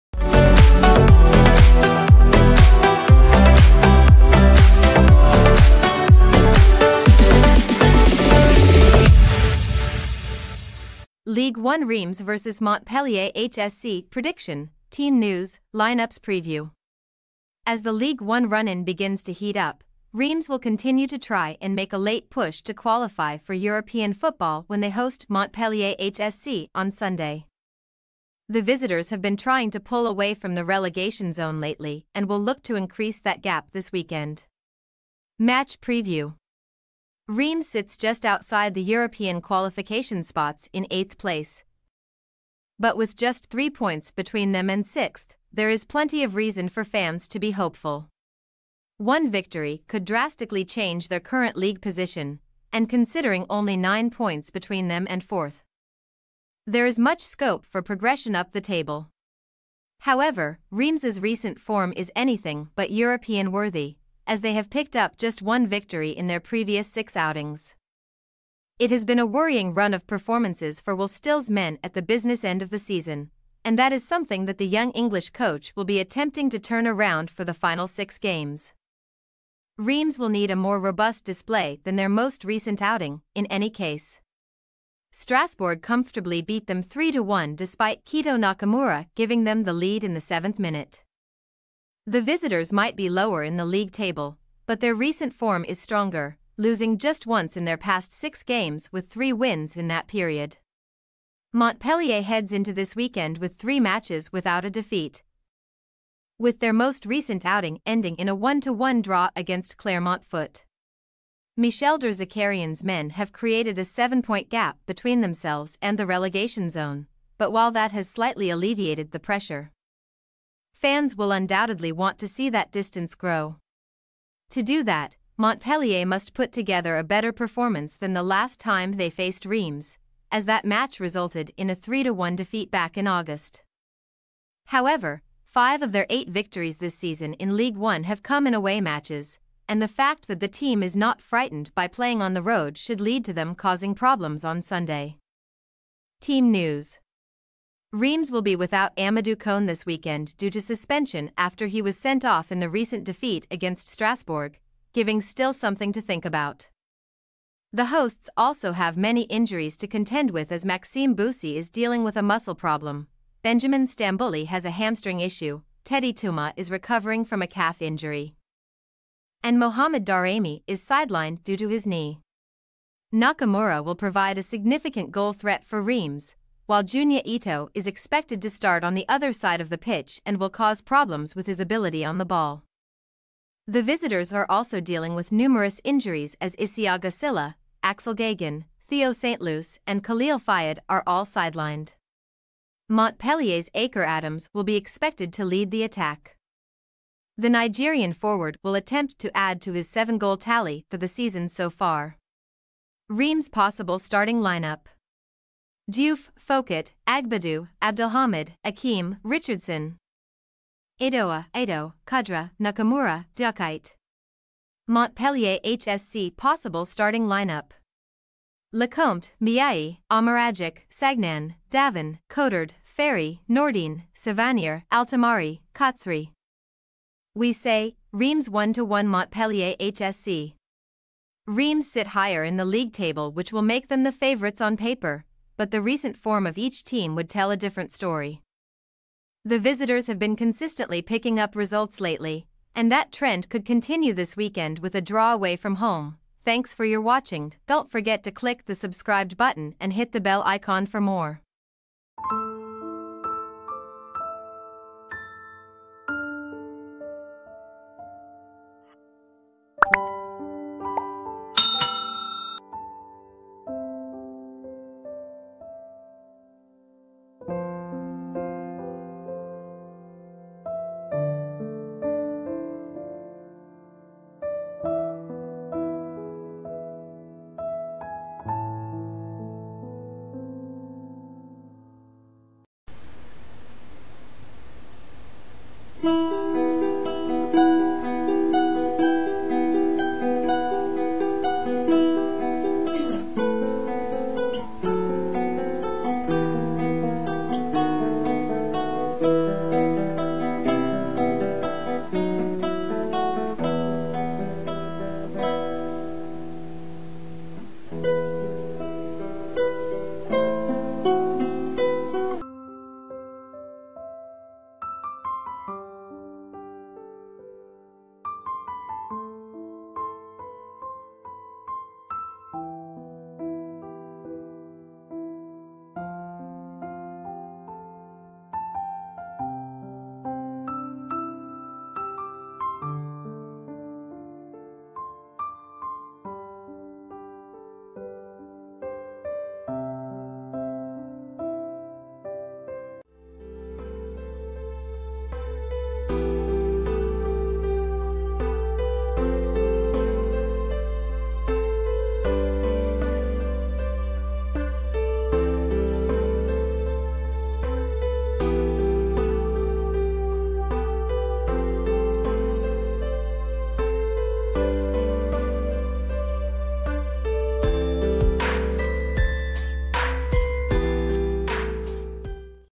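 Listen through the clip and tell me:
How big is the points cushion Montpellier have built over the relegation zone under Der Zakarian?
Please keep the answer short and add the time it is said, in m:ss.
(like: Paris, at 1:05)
7 points, at 1:53.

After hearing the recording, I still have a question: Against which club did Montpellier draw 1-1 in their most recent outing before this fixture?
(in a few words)
Clermont Foot.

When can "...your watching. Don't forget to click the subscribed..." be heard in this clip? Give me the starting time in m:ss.
4:06.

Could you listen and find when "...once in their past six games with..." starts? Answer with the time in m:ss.
1:37.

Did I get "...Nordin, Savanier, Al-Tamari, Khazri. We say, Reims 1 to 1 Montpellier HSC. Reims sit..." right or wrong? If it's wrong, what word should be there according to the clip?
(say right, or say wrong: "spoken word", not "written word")
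right.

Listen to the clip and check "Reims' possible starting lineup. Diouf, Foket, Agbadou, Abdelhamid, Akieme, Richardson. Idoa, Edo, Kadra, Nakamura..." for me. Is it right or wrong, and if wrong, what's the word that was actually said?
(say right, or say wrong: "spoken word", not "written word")
right.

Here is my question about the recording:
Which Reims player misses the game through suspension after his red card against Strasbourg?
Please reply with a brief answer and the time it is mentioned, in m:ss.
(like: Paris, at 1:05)
Amadou Koné, at 2:28.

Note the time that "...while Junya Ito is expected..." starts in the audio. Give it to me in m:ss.
2:56.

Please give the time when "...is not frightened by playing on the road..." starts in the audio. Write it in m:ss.
2:20.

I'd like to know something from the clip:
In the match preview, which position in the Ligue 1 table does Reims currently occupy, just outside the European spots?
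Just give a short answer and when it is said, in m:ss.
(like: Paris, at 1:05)
8th, at 0:40.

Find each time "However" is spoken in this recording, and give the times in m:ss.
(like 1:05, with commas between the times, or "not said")
1:00, 2:14.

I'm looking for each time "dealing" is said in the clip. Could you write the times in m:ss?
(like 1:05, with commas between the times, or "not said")
2:41, 3:04.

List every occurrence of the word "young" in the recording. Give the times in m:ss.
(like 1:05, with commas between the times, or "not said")
1:14.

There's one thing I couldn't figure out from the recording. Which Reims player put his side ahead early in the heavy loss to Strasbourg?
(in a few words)
Keito Nakamura.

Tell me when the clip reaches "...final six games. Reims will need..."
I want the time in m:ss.
1:17.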